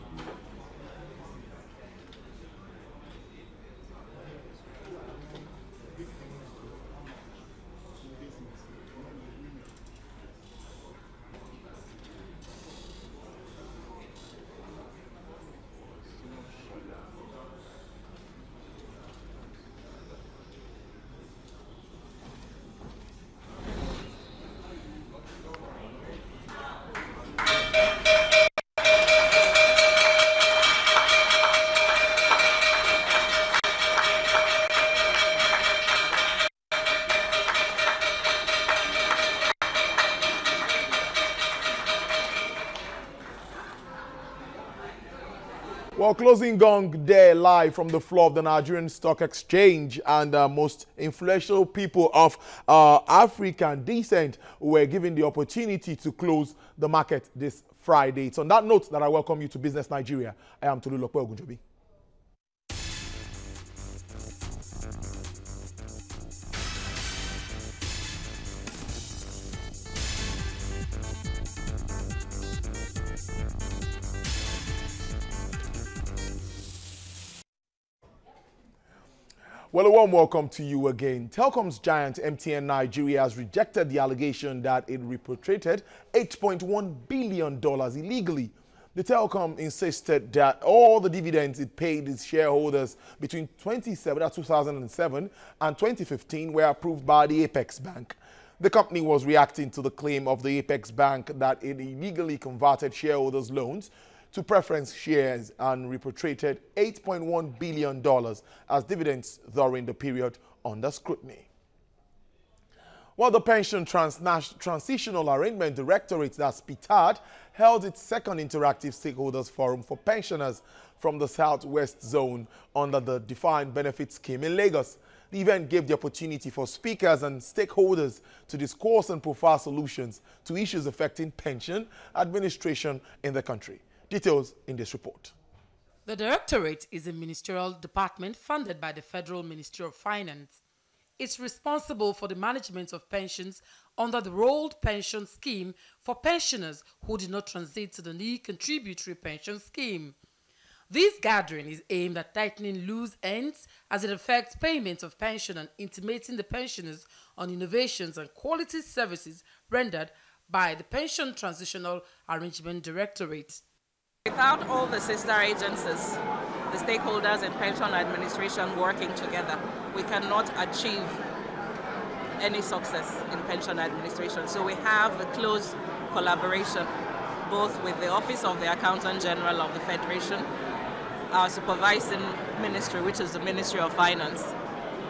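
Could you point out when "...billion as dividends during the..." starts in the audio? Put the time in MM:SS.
01:47.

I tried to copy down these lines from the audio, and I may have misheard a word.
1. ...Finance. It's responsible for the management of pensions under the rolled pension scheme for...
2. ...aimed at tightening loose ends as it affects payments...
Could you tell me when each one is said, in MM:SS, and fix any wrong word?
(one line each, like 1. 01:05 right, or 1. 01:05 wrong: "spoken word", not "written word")
1. 02:19 right
2. 02:31 right.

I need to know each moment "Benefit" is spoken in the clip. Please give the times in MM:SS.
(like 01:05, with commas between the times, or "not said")
02:03.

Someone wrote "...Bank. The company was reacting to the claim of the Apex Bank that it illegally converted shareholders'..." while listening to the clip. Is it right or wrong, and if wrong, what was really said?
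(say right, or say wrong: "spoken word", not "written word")
right.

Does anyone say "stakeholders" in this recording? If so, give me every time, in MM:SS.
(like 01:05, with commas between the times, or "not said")
01:58, 02:07, 02:46.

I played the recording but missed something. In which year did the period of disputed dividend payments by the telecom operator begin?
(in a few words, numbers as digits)
2007.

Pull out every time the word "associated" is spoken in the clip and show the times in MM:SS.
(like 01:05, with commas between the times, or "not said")
not said.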